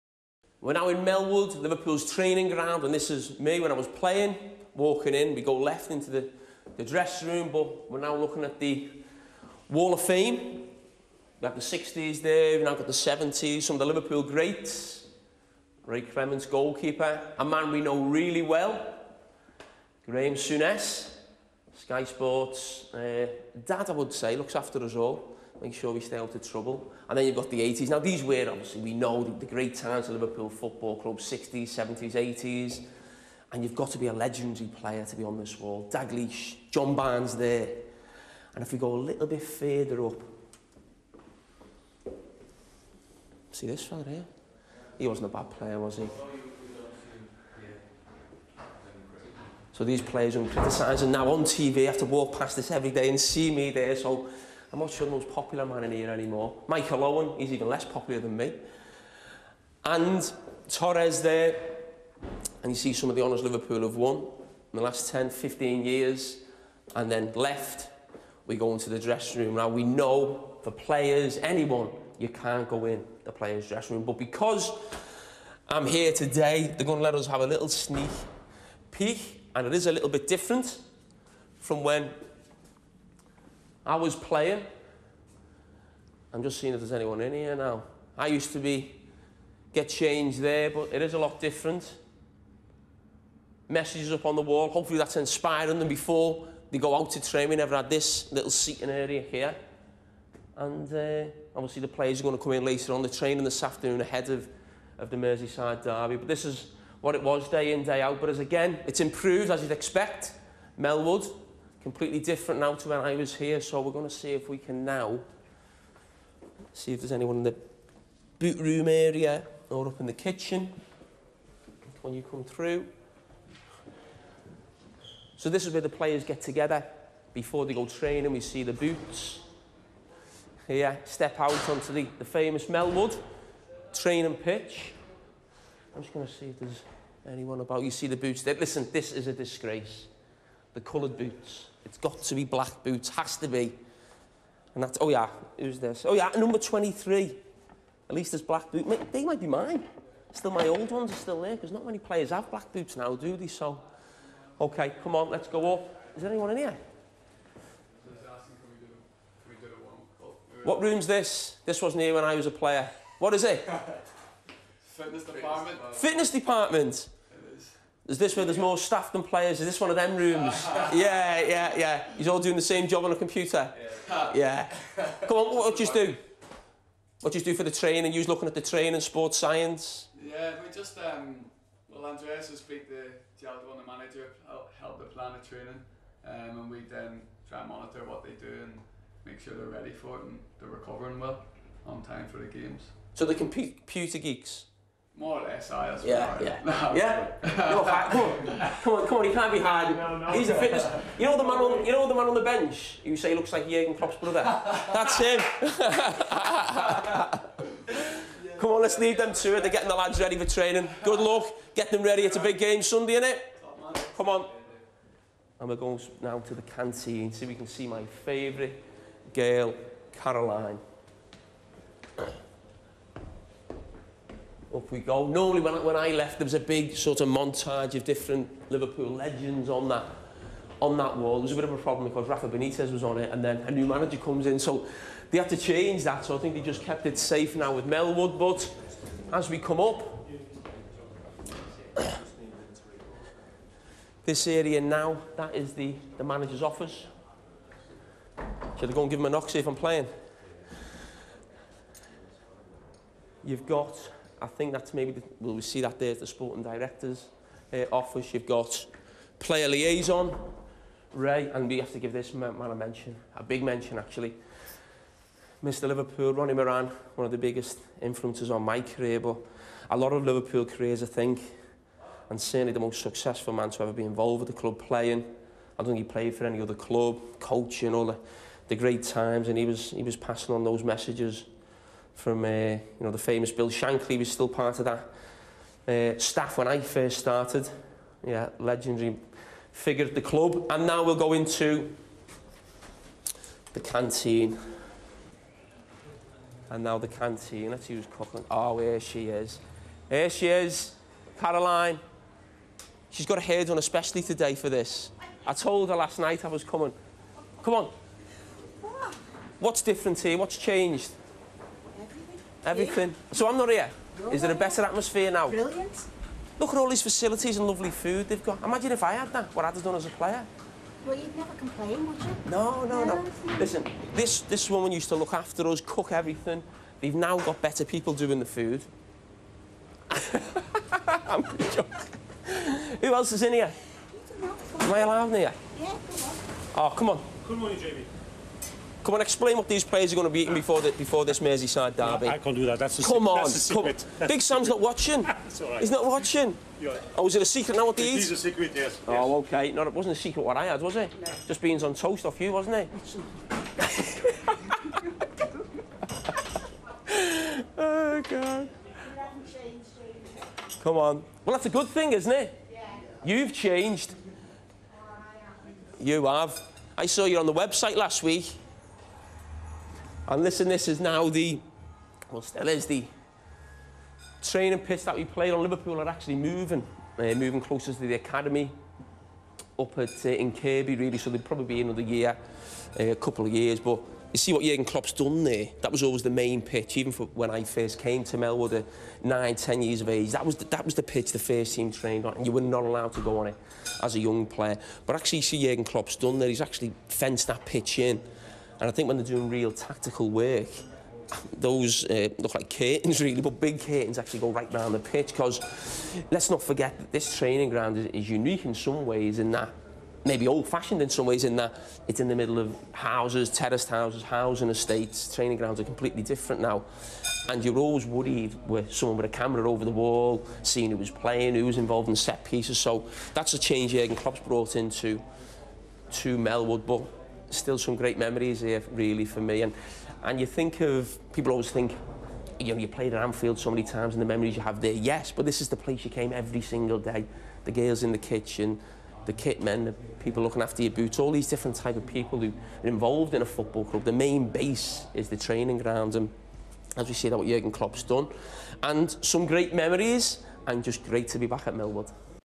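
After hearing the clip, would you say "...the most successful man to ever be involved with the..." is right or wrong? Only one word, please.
right.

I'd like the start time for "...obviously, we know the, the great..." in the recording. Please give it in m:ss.
0:28.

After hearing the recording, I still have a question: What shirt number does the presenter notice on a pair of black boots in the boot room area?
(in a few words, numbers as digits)
23.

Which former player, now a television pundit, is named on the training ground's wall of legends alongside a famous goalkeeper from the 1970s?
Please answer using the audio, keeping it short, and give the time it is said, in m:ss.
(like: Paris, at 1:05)
Graham Souness, at 0:20.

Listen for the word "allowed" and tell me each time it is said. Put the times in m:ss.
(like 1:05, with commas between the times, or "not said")
5:34, 6:32.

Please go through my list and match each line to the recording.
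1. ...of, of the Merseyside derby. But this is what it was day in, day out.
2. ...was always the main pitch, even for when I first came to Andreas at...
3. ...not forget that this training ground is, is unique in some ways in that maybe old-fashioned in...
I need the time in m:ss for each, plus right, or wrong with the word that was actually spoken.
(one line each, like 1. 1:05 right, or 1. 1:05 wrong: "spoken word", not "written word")
1. 1:44 right
2. 6:25 wrong: "Melwood", not "Andreas"
3. 6:46 right.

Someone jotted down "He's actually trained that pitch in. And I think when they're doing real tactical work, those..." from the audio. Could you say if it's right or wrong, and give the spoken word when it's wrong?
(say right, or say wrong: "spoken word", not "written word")
wrong: "fenced", not "trained".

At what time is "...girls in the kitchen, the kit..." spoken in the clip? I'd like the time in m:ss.
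7:17.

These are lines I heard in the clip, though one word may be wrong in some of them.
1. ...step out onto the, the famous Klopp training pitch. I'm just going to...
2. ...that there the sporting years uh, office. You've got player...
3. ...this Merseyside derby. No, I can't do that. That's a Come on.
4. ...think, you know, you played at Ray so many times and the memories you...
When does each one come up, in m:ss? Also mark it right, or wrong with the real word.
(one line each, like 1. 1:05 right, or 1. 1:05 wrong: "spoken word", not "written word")
1. 2:11 wrong: "Melwood", not "Klopp"
2. 4:15 wrong: "directors", not "years"
3. 5:41 right
4. 7:11 wrong: "Anfield", not "Ray".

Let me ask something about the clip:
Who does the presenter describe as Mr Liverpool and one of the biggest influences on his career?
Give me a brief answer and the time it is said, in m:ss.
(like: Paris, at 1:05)
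Ronnie Moran, at 4:26.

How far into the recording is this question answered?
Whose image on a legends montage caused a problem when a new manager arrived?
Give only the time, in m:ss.
3:52.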